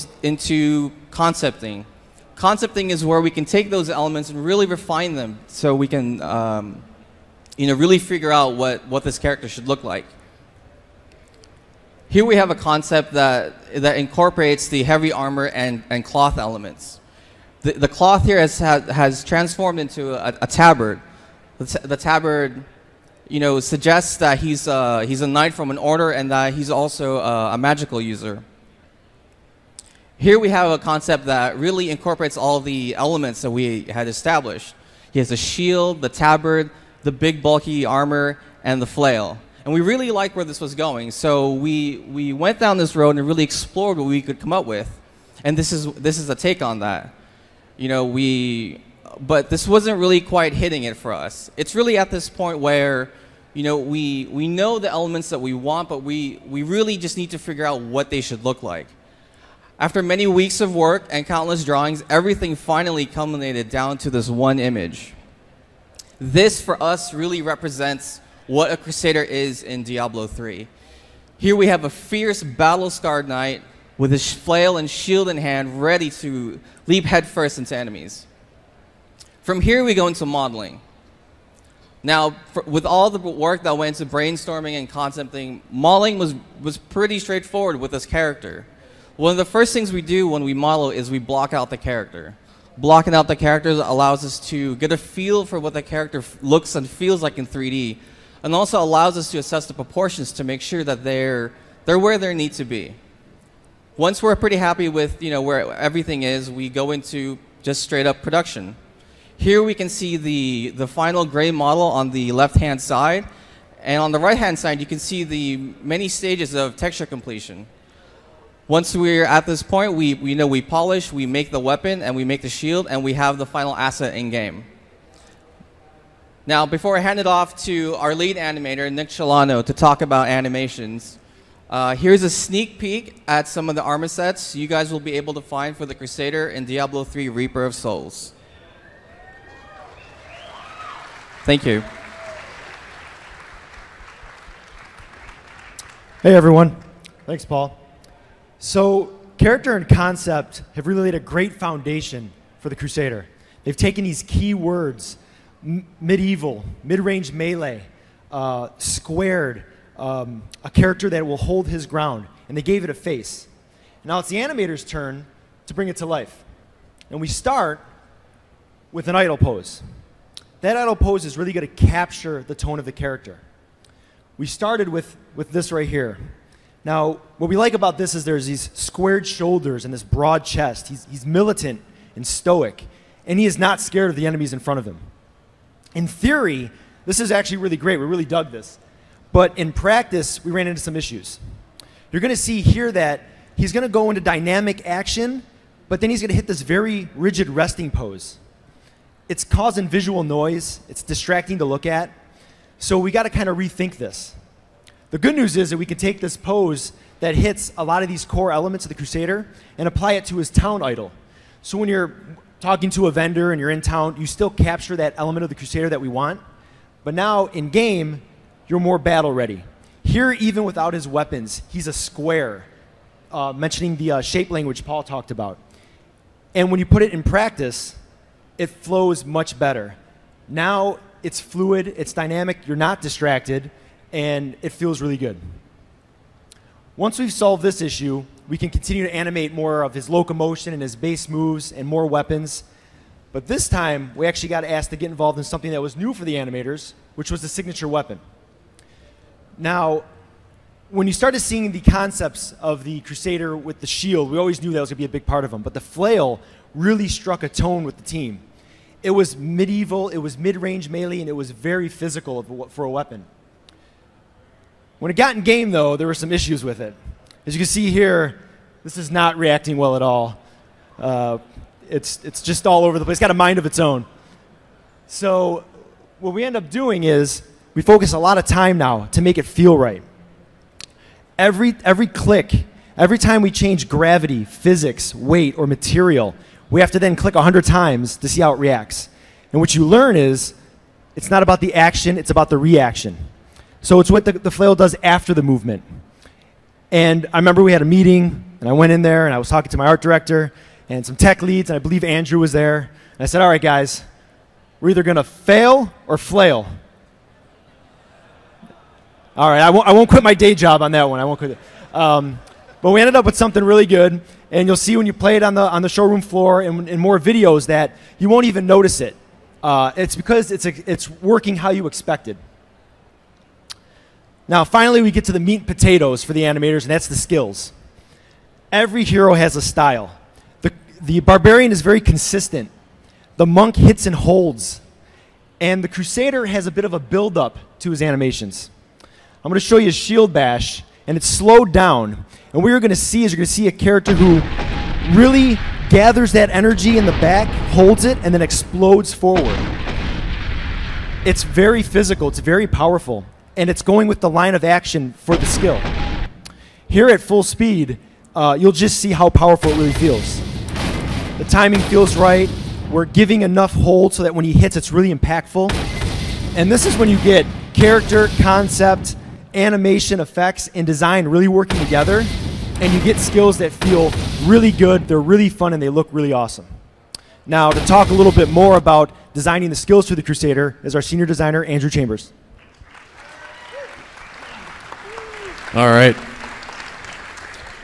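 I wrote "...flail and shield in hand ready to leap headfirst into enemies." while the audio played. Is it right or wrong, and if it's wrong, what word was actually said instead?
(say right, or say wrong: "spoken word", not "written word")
right.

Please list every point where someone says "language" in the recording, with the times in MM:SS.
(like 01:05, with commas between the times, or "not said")
03:44.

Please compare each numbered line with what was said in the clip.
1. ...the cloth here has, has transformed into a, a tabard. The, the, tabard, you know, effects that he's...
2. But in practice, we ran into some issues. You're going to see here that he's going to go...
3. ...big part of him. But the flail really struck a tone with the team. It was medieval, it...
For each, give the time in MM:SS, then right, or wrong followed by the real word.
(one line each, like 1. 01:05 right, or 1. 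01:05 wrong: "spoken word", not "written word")
1. 00:17 wrong: "suggests", not "effects"
2. 03:09 right
3. 04:15 right.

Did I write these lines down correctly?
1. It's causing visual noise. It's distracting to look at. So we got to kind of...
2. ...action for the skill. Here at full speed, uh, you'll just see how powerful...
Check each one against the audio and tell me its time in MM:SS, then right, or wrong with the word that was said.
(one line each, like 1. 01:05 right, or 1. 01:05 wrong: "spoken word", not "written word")
1. 03:19 right
2. 05:54 right.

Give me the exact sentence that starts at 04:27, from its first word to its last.
As you can see here, this is not reacting well at all.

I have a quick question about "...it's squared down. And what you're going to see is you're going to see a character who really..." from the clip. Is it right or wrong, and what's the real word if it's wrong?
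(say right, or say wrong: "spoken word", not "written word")
wrong: "slowed", not "squared".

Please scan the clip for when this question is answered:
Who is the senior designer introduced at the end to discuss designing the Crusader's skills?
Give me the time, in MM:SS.
06:21.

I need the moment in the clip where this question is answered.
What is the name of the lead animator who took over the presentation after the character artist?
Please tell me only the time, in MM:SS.
02:08.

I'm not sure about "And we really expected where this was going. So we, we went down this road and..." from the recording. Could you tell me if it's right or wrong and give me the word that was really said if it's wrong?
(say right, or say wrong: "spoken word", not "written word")
wrong: "liked", not "expected".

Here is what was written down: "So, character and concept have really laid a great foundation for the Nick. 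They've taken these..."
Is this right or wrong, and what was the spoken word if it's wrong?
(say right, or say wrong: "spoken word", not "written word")
wrong: "Crusader", not "Nick".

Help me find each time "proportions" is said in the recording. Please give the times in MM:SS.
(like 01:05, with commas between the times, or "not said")
01:39.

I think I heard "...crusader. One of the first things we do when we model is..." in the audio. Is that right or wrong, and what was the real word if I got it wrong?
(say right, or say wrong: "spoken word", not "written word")
wrong: "character", not "crusader".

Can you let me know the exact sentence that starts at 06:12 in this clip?
And you get skills that feel really good, they're really fun, and they look really awesome.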